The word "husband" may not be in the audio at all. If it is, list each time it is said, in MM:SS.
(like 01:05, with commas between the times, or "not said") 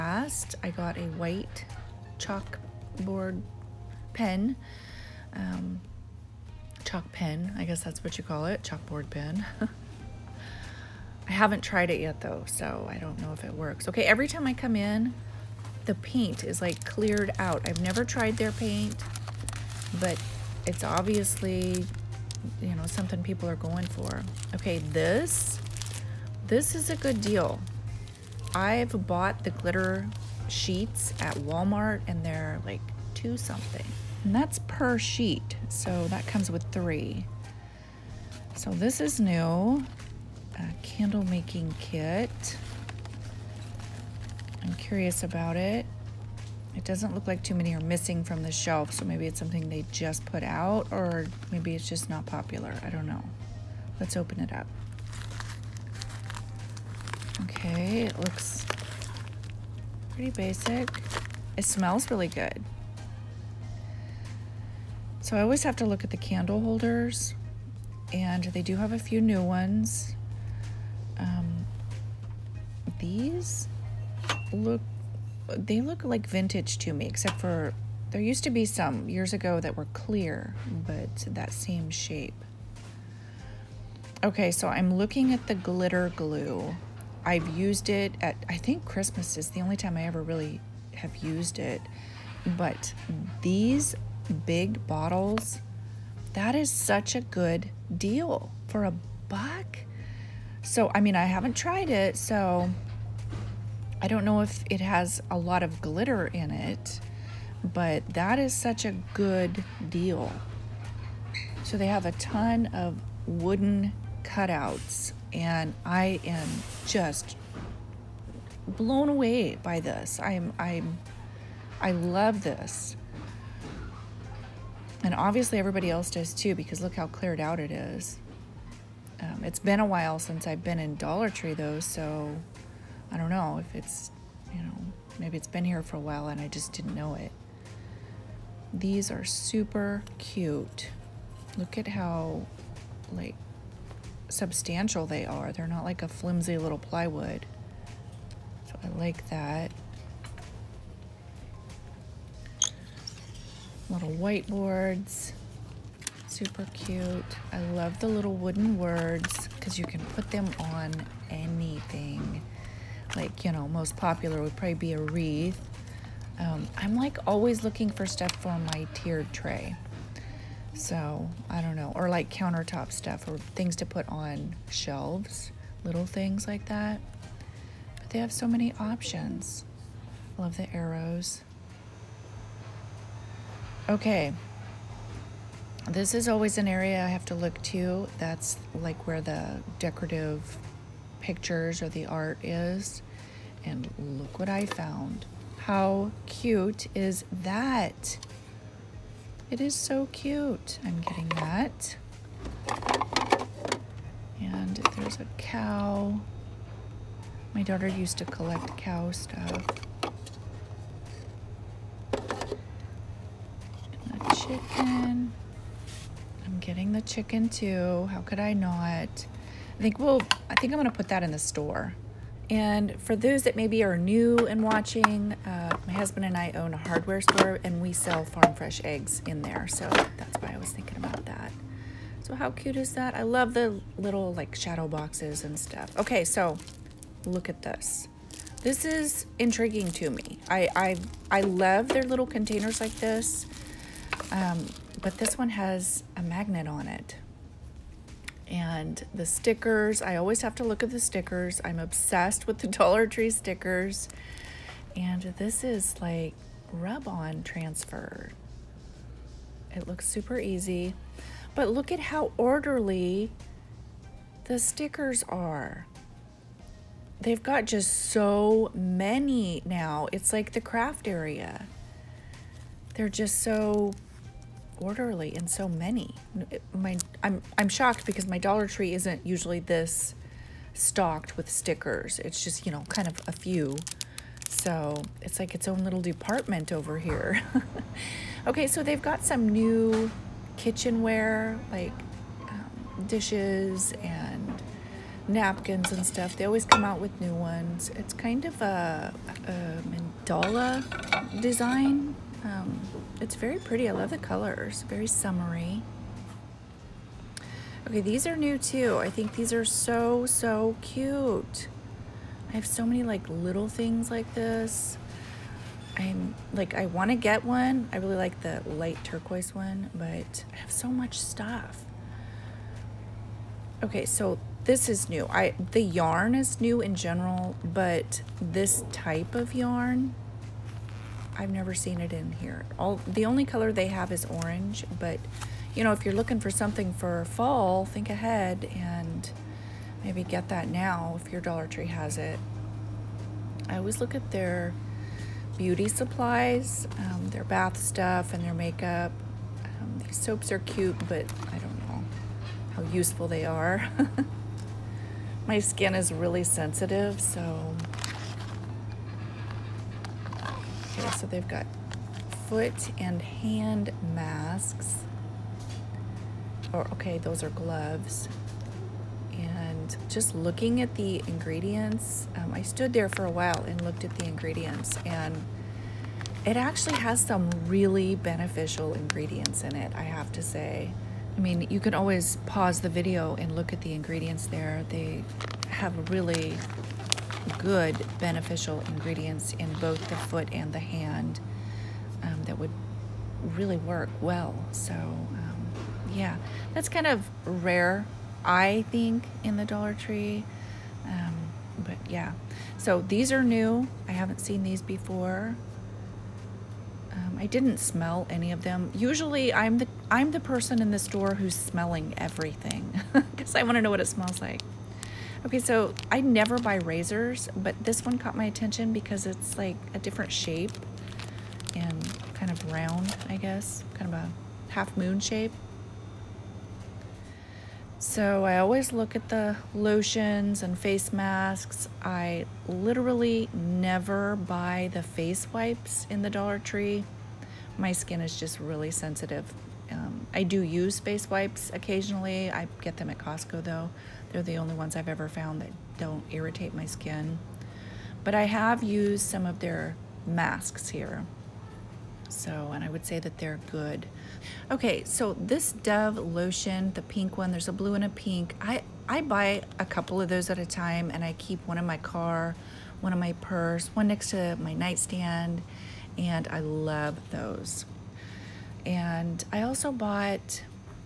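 03:45.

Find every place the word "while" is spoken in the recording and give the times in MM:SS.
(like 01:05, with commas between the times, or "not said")
02:09, 02:16, 06:13.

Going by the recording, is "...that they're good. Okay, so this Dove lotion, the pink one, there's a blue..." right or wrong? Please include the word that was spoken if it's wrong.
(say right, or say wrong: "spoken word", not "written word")
right.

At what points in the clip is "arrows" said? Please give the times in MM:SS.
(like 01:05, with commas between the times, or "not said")
03:00.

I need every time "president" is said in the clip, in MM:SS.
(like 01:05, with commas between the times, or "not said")
not said.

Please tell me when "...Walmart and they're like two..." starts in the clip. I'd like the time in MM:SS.
00:31.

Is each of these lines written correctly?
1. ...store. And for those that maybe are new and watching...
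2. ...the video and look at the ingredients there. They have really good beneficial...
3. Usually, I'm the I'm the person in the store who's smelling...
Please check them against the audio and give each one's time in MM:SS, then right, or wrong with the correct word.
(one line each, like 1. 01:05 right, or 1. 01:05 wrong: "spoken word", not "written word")
1. 03:41 right
2. 06:22 right
3. 06:48 right.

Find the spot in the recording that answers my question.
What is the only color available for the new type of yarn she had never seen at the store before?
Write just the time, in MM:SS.
05:34.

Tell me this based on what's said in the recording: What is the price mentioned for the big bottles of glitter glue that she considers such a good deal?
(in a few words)
a buck.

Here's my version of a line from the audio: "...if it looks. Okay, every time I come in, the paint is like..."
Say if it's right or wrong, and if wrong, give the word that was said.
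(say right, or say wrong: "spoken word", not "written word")
wrong: "works", not "looks".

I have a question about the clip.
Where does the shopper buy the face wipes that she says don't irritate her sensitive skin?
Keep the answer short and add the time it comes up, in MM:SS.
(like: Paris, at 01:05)
Costco, at 07:23.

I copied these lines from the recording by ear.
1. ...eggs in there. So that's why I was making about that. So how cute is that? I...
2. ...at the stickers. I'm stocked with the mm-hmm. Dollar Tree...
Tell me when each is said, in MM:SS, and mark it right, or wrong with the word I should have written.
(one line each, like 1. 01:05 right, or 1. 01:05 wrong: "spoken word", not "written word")
1. 03:48 wrong: "thinking", not "making"
2. 04:10 wrong: "obsessed", not "stocked".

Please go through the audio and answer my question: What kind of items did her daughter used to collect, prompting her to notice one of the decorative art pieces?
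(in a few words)
cow stuff.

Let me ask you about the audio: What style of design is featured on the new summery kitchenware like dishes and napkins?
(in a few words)
mandala.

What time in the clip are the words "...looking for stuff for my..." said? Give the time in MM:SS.
02:47.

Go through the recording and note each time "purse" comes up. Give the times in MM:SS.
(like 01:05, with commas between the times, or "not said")
07:43.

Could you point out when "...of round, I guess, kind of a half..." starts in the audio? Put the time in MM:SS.
07:02.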